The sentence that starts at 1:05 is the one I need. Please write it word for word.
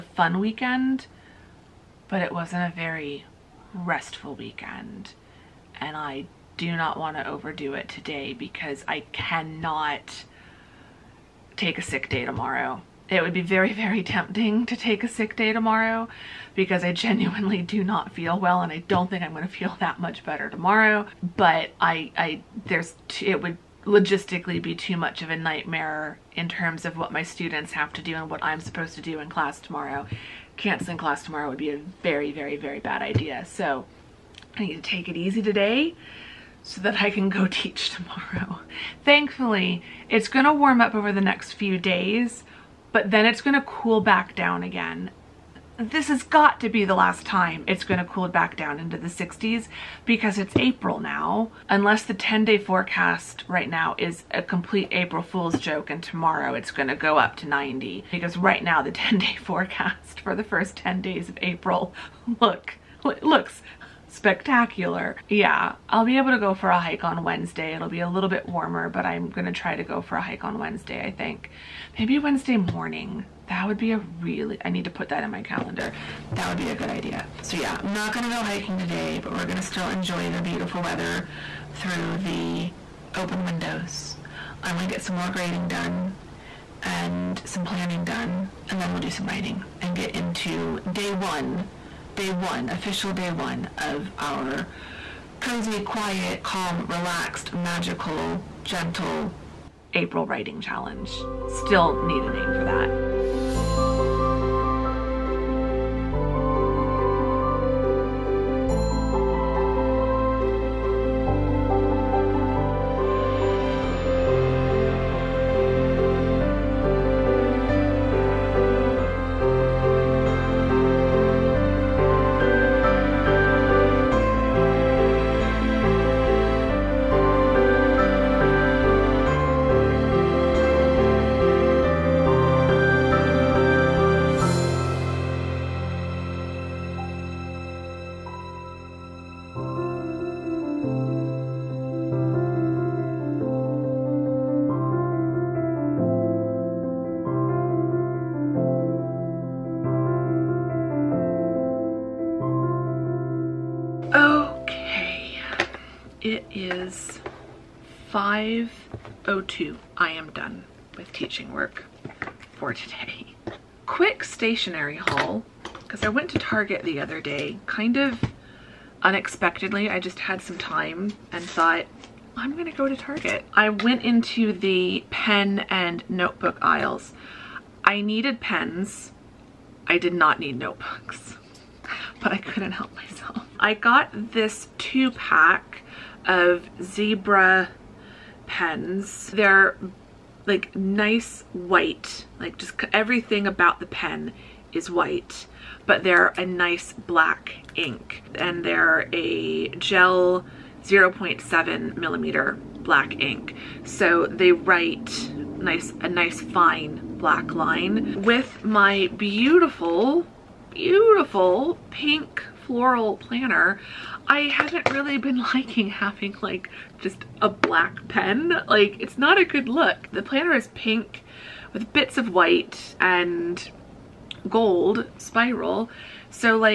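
Yeah, I'll be able to go for a hike on Wednesday.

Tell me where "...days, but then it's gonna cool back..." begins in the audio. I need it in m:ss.
0:41.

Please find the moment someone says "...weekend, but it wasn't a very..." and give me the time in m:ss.
0:00.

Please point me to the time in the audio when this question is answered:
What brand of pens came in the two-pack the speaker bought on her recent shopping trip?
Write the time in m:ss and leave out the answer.
3:06.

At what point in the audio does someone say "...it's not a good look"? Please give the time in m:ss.
3:38.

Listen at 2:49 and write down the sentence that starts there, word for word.
I just had some time and thought, I'm gonna go to Target.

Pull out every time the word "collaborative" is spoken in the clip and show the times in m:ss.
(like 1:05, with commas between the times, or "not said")
not said.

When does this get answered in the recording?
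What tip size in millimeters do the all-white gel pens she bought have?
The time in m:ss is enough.
3:20.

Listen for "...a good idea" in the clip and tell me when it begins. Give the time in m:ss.
1:16.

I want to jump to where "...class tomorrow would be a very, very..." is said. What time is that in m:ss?
0:30.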